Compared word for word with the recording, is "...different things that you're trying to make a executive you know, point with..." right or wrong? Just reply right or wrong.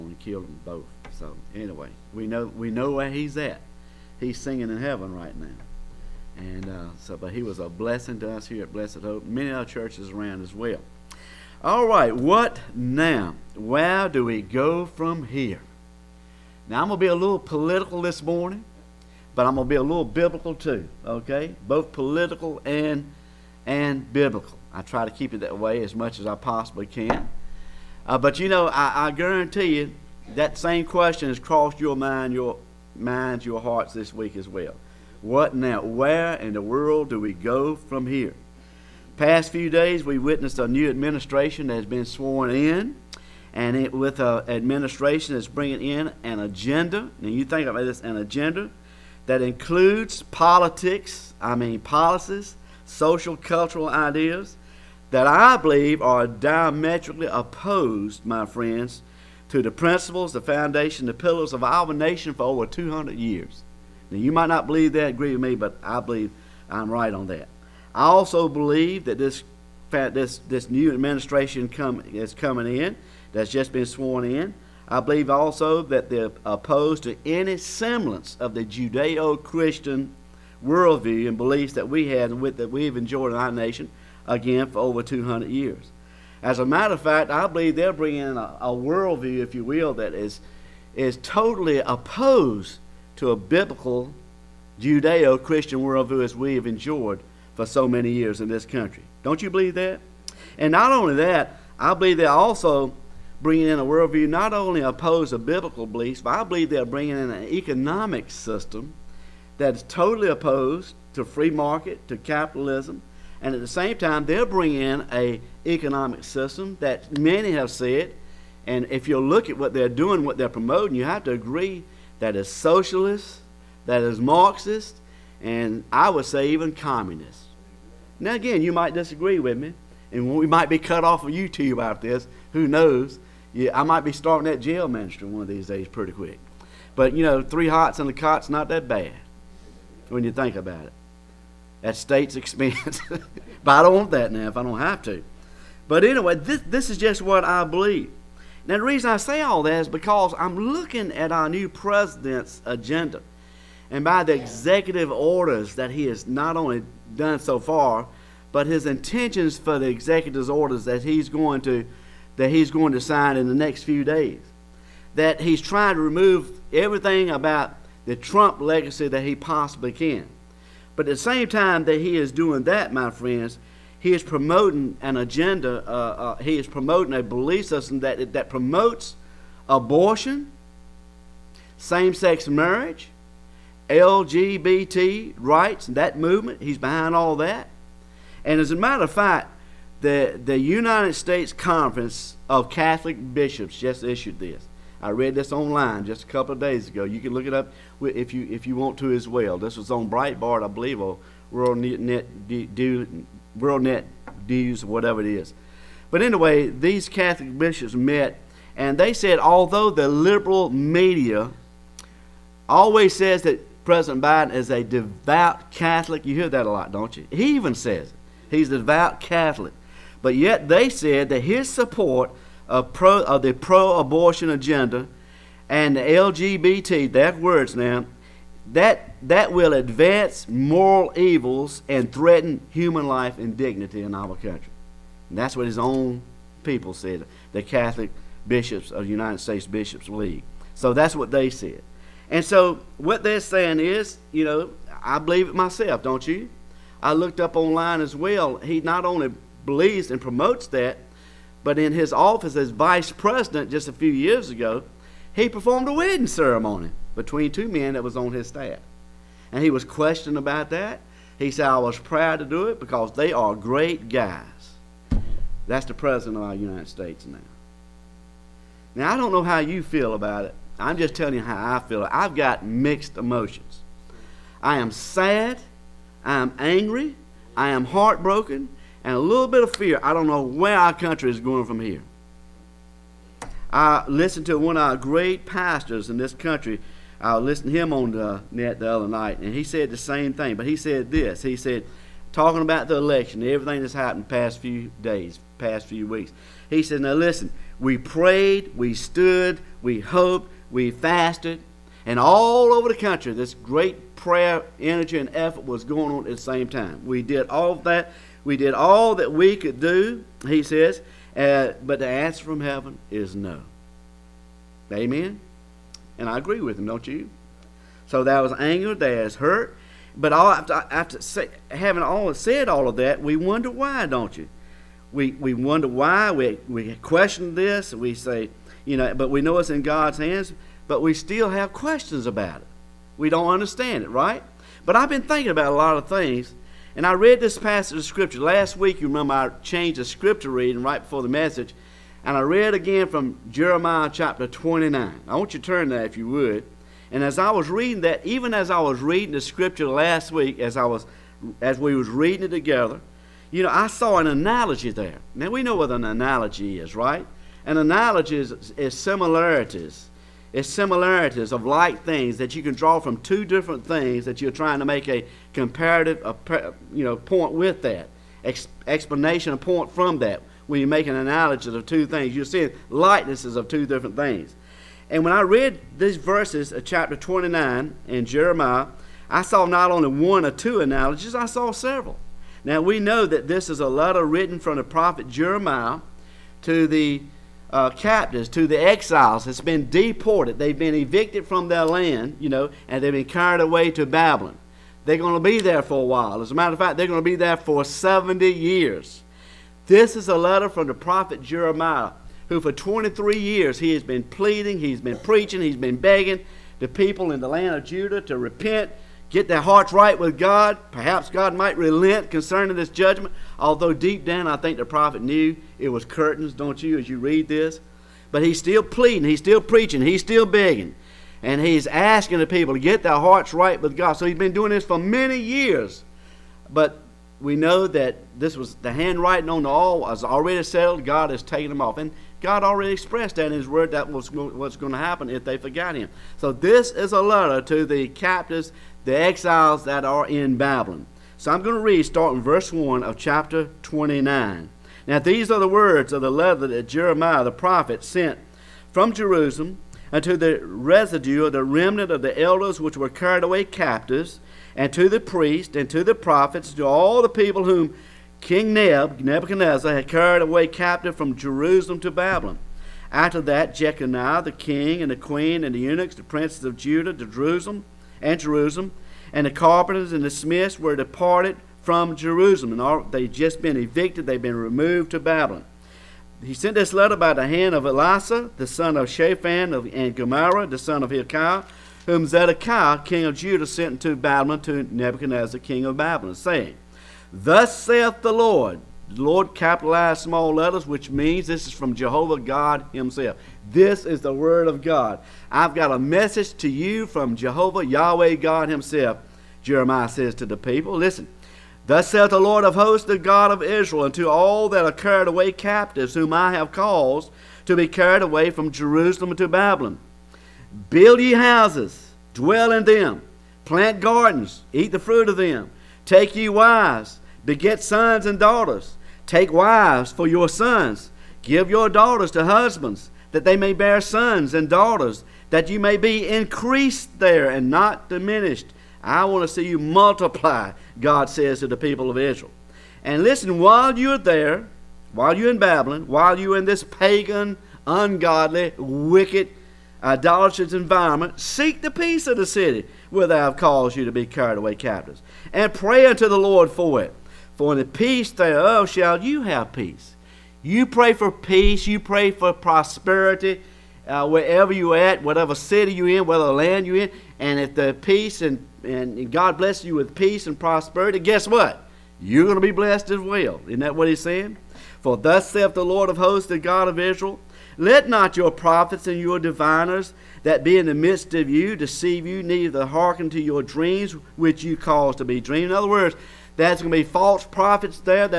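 wrong.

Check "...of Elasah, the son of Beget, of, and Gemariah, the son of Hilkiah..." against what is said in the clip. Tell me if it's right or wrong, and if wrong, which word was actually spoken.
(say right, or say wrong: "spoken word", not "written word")
wrong: "Shaphan", not "Beget".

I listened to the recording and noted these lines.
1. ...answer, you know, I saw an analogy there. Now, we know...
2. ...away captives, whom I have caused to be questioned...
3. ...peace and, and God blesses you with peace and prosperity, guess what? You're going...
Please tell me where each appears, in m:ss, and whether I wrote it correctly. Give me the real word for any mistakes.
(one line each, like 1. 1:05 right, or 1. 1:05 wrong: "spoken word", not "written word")
1. 5:52 wrong: "together", not "answer"
2. 8:25 wrong: "carried", not "questioned"
3. 9:18 right.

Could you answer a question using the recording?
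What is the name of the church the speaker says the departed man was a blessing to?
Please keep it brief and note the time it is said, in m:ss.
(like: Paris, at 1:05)
Blessed Hope, at 0:08.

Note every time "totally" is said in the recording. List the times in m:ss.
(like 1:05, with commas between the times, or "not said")
1:31, 1:49.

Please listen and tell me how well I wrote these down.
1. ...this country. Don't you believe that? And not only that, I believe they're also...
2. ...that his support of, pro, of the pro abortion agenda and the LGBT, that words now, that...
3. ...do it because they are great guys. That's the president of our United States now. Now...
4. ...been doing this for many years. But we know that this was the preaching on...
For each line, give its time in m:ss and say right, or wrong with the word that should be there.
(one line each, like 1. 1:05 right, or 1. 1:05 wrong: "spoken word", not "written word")
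1. 1:38 right
2. 3:41 right
3. 4:22 right
4. 7:04 wrong: "handwriting", not "preaching".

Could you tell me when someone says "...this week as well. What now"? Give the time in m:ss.
0:33.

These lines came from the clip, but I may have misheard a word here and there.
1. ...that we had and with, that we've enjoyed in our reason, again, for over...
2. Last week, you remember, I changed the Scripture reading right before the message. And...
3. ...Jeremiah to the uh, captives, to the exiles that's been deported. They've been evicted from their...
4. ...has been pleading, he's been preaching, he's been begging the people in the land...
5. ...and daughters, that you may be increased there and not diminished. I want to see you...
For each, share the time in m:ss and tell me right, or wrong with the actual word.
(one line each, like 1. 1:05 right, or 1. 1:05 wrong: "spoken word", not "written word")
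1. 1:21 wrong: "nation", not "reason"
2. 5:38 right
3. 6:25 right
4. 6:43 right
5. 8:44 right.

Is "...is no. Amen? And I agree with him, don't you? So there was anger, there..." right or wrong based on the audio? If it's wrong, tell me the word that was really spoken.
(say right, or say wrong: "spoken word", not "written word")
right.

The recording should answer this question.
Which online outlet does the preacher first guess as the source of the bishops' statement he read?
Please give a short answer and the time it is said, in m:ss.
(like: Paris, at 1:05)
Breitbart, at 3:20.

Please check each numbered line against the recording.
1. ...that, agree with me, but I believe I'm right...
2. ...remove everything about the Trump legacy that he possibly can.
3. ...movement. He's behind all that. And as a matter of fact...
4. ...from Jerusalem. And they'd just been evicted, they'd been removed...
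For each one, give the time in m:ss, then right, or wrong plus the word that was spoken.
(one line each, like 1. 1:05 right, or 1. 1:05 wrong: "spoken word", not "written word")
1. 1:04 right
2. 2:46 right
3. 3:06 right
4. 7:51 right.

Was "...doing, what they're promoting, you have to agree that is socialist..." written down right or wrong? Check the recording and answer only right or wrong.
right.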